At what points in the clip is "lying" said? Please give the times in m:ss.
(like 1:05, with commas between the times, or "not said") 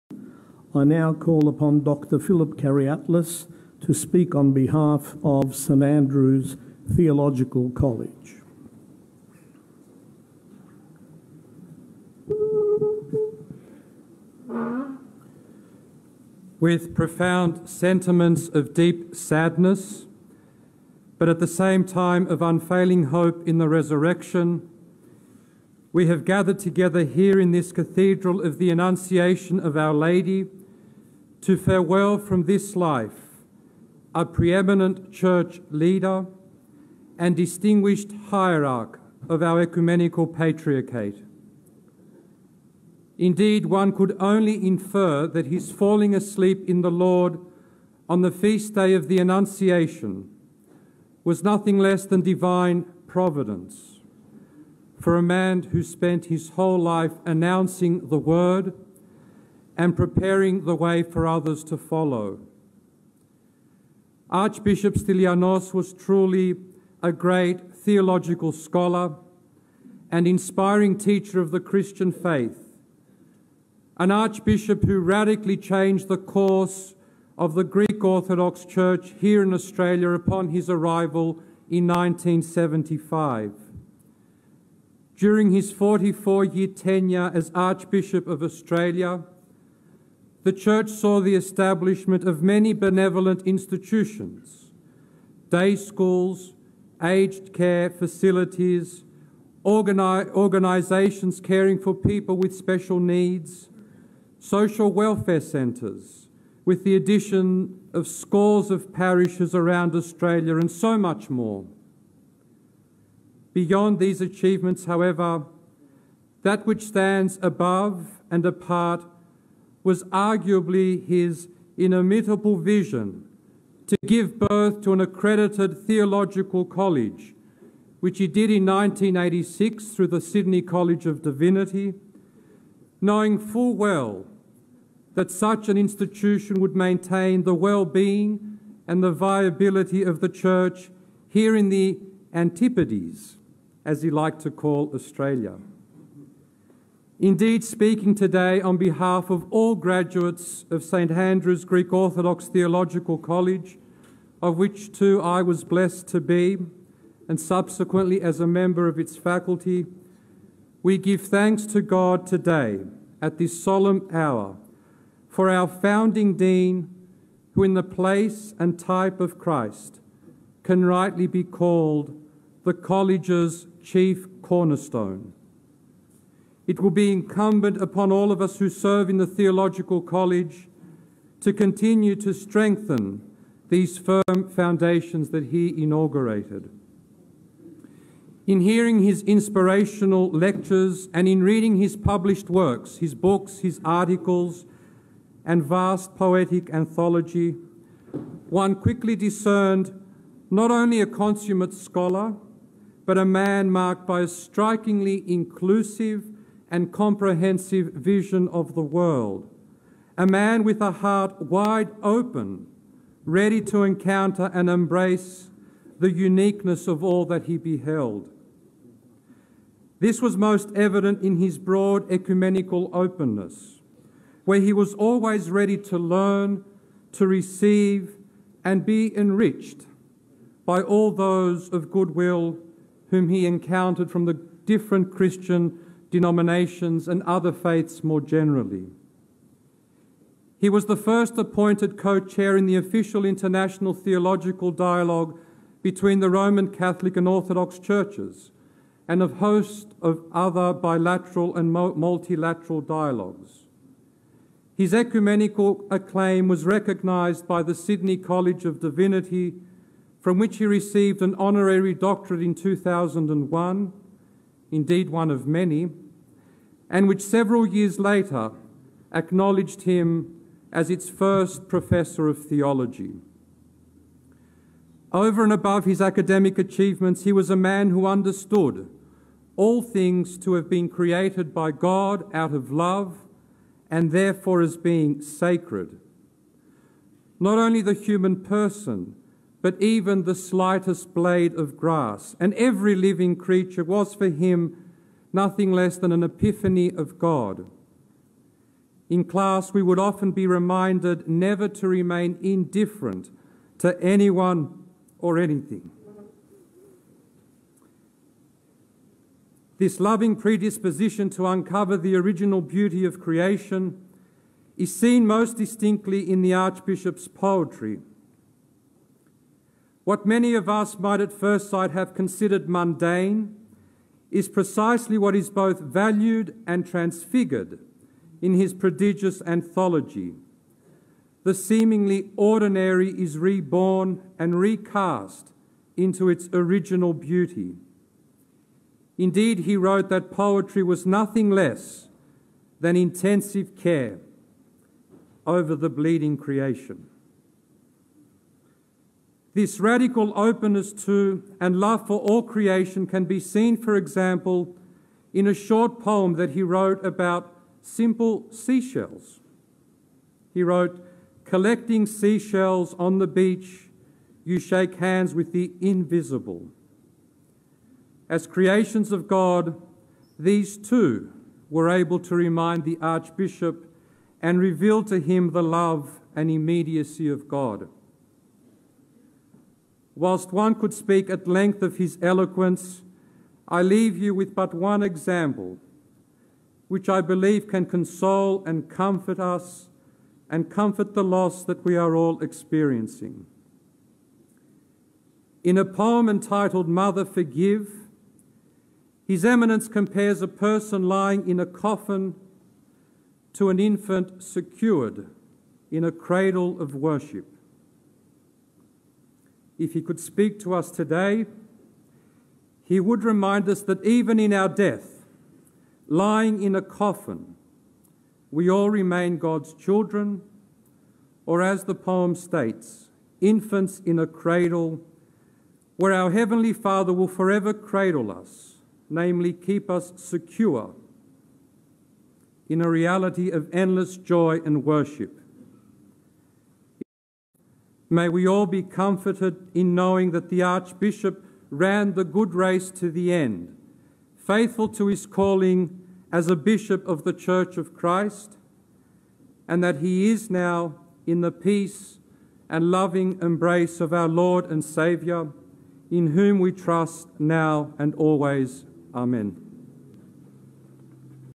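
6:41, 6:56.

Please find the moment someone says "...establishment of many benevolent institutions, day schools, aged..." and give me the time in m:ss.
1:31.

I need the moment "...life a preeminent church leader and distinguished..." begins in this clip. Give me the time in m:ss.
0:32.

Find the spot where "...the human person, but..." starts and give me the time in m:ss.
4:47.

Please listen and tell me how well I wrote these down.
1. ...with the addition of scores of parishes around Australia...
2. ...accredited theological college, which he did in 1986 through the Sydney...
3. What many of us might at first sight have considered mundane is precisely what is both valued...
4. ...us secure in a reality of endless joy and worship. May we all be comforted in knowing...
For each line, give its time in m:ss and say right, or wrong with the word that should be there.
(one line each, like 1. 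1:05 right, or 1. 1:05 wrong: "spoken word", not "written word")
1. 1:46 right
2. 2:05 right
3. 5:20 right
4. 7:09 right.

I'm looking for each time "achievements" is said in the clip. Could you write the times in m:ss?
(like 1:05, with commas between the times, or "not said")
1:54, 4:36.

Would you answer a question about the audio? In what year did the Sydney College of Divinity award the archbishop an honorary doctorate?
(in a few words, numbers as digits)
2001.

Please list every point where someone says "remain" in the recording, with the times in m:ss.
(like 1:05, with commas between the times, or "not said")
5:01, 6:58.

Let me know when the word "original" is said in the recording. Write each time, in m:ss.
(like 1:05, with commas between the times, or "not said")
5:12, 5:36.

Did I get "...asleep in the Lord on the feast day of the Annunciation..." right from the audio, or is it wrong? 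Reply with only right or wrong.
right.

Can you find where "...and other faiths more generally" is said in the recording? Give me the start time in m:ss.
3:57.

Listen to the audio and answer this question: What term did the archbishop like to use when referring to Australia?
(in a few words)
the Antipodes.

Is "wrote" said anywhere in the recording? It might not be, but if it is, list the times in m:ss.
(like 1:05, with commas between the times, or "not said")
5:39, 5:56, 6:00.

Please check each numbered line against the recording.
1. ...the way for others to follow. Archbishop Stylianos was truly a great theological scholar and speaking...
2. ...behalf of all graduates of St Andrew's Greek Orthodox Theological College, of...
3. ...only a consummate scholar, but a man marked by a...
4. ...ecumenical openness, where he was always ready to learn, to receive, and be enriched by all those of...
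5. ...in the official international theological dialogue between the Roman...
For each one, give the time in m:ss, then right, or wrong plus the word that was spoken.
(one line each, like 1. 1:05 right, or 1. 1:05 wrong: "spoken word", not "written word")
1. 1:00 wrong: "inspiring", not "speaking"
2. 2:28 right
3. 3:20 right
4. 3:42 right
5. 4:02 right.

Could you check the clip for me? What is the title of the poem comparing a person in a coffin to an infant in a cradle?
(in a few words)
Mother Forgive.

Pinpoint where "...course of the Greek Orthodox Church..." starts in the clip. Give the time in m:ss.
1:16.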